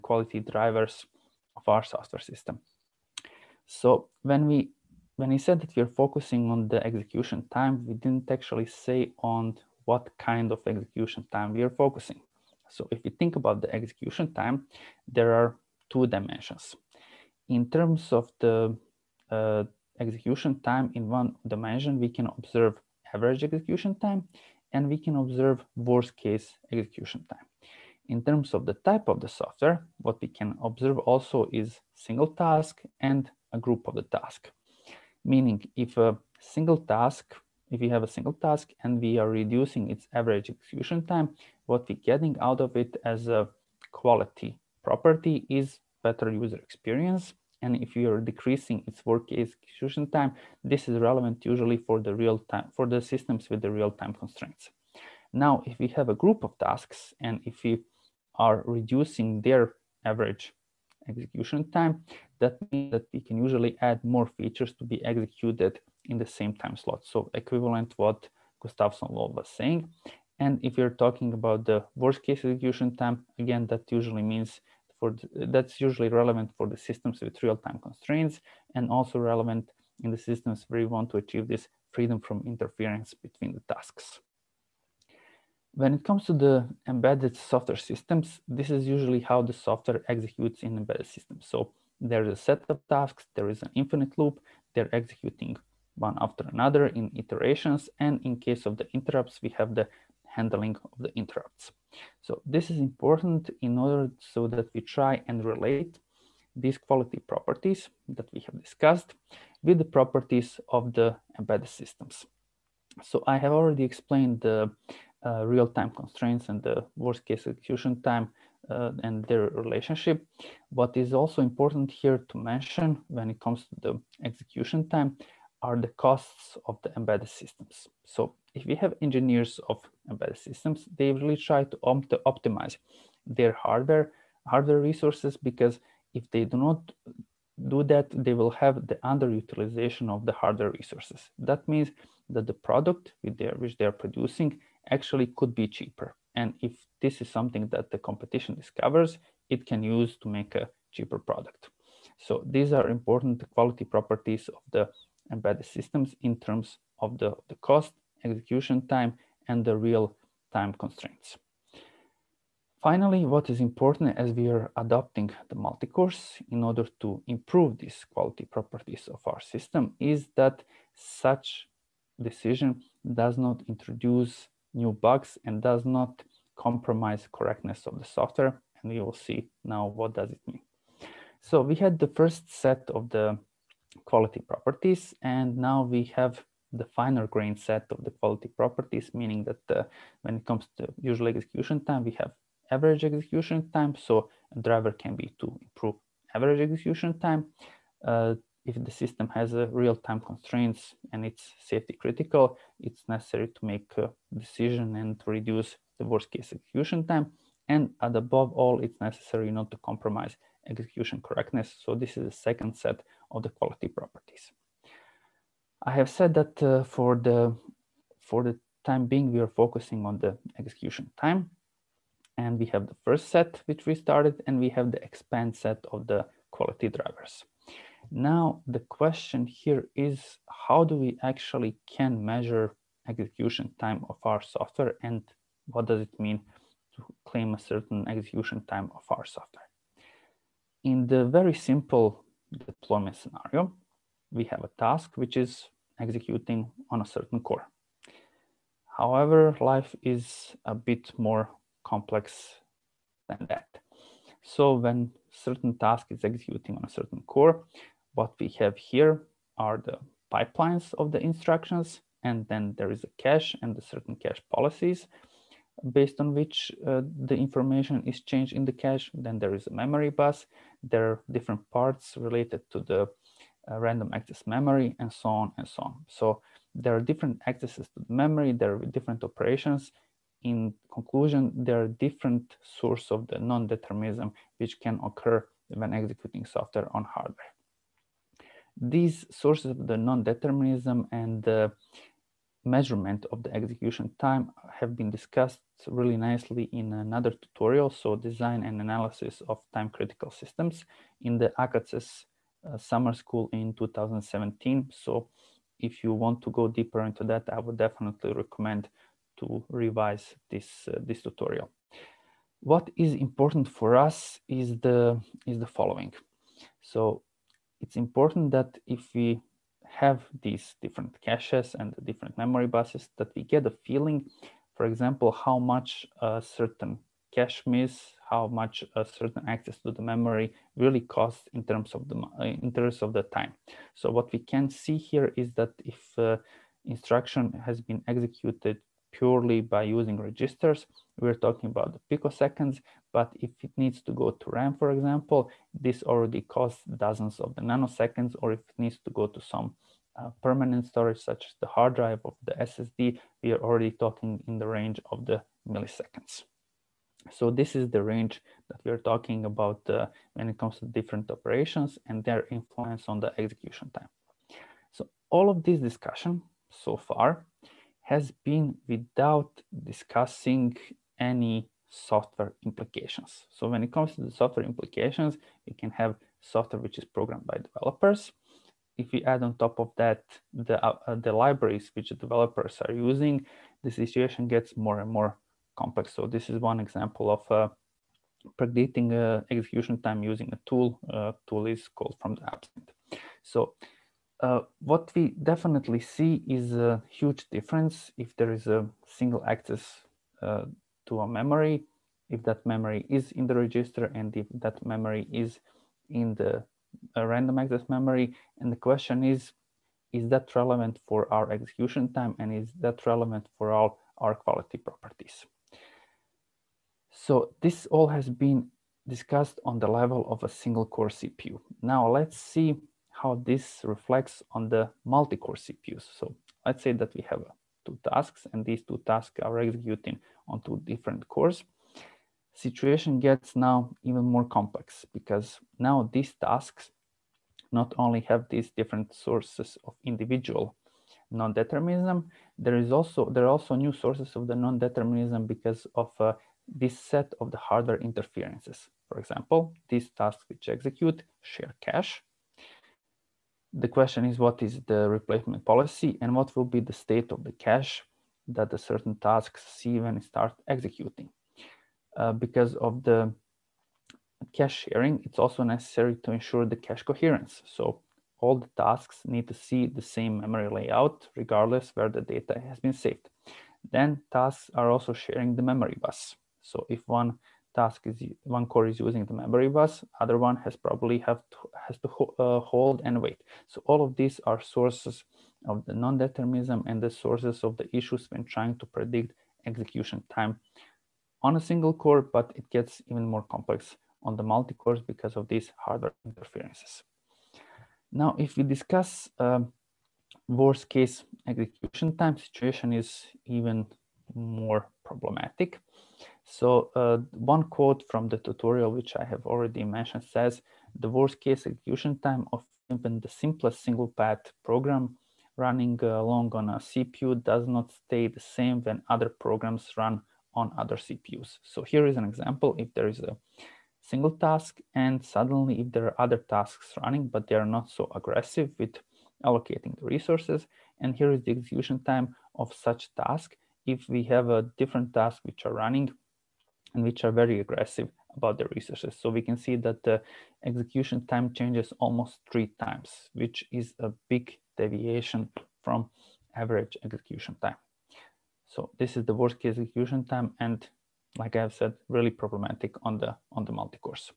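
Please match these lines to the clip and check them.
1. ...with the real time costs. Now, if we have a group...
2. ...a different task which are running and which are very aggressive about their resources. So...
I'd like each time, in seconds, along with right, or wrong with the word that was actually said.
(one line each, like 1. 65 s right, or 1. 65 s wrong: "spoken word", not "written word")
1. 53 s wrong: "constraints", not "costs"
2. 534 s right.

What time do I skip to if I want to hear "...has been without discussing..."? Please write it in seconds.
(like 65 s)
368 s.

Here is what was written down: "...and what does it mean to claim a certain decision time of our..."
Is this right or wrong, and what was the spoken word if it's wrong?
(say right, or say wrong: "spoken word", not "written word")
wrong: "execution", not "decision".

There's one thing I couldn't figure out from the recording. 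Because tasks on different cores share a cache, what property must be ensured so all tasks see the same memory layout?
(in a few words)
cache coherence.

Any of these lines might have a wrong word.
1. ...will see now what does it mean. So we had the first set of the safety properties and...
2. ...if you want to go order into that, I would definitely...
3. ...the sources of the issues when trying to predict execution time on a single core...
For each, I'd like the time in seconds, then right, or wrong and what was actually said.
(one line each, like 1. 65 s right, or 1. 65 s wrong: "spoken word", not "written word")
1. 178 s wrong: "quality", not "safety"
2. 305 s wrong: "deeper", not "order"
3. 487 s right.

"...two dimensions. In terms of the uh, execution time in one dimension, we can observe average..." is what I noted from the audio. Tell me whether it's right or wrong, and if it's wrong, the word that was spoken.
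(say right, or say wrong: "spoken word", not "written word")
right.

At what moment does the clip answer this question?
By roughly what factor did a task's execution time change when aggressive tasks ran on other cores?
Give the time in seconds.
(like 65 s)
542 s.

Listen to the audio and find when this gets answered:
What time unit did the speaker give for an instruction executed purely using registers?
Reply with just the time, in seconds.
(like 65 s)
342 s.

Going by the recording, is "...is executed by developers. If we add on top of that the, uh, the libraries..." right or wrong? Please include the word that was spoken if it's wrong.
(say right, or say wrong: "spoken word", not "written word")
wrong: "programmed", not "executed".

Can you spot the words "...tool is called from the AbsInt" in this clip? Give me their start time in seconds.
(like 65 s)
391 s.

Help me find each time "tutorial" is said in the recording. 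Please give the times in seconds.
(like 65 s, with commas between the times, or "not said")
297 s, 311 s, 508 s.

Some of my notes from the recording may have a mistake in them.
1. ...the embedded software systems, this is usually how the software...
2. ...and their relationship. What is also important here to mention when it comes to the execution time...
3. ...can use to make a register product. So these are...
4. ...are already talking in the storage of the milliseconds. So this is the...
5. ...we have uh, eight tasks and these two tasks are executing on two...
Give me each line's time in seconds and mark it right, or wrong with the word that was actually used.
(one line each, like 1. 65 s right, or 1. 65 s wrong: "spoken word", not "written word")
1. 86 s right
2. 119 s right
3. 149 s wrong: "cheaper", not "register"
4. 353 s wrong: "range", not "storage"
5. 427 s wrong: "two", not "eight".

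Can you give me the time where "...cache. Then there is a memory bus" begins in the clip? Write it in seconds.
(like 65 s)
268 s.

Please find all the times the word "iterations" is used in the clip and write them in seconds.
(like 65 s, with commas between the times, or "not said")
97 s.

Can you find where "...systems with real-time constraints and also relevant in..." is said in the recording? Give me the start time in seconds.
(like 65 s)
76 s.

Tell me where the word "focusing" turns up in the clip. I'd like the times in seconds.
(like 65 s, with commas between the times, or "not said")
6 s, 11 s, 219 s.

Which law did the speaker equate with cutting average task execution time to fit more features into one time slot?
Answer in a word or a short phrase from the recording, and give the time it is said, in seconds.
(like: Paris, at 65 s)
Gustafson law, at 68 s.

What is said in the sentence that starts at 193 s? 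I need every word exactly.
So a driver can be to improve average execution time.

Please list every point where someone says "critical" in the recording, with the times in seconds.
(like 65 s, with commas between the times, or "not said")
201 s, 299 s.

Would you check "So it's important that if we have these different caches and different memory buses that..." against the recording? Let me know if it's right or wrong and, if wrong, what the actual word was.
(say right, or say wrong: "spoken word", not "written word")
right.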